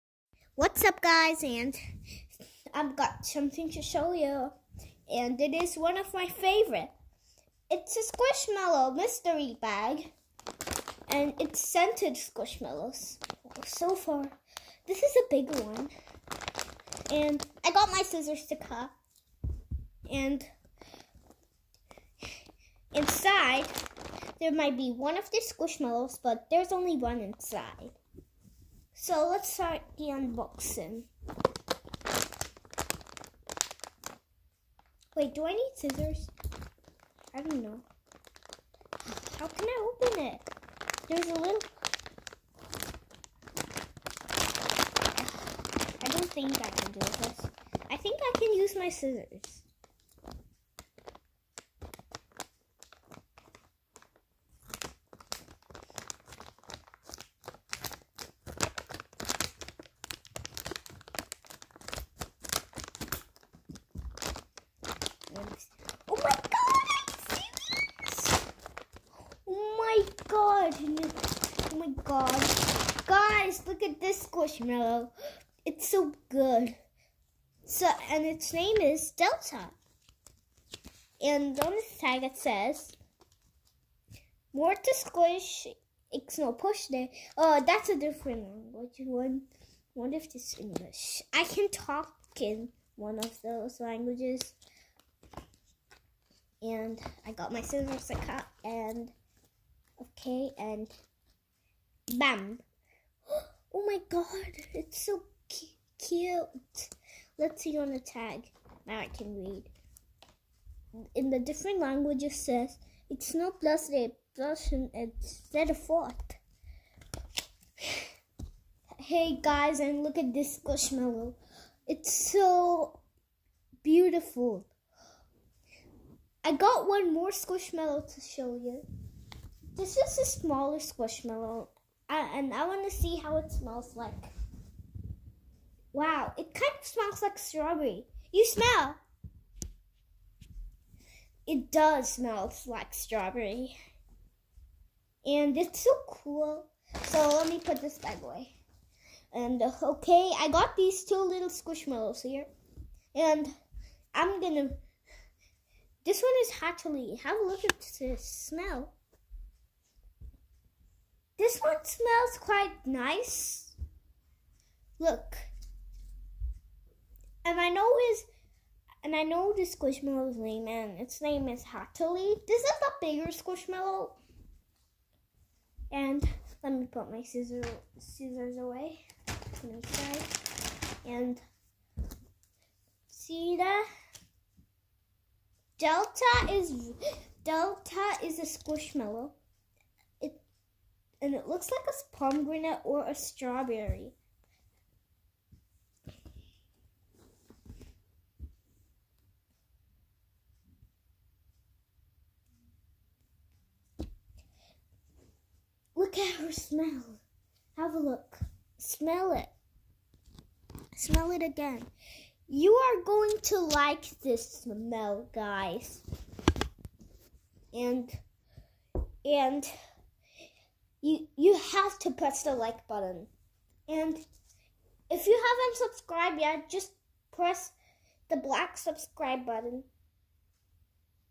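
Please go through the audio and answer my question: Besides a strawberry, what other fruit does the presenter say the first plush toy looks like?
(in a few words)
Pomegranate.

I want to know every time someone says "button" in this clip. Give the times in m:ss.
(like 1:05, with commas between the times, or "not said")
3:42, 3:49.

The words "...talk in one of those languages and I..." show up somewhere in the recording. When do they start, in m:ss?
1:31.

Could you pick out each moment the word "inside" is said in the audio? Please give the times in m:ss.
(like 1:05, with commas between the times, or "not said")
0:22, 0:27.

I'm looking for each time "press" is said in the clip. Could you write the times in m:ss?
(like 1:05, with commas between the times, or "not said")
3:42, 3:47.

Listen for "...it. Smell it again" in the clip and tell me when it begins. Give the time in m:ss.
3:29.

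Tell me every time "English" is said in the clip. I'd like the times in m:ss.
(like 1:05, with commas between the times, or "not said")
1:30.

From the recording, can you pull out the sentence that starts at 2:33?
And I'm gonna this one is Hatchily.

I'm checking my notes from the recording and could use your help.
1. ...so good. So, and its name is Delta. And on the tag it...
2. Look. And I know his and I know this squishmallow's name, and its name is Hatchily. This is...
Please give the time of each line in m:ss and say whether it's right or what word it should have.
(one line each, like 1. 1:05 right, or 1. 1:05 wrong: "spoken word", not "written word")
1. 1:15 right
2. 2:44 right.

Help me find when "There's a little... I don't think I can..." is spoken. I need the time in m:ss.
0:41.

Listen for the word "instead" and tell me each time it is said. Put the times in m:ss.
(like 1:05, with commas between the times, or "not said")
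1:54.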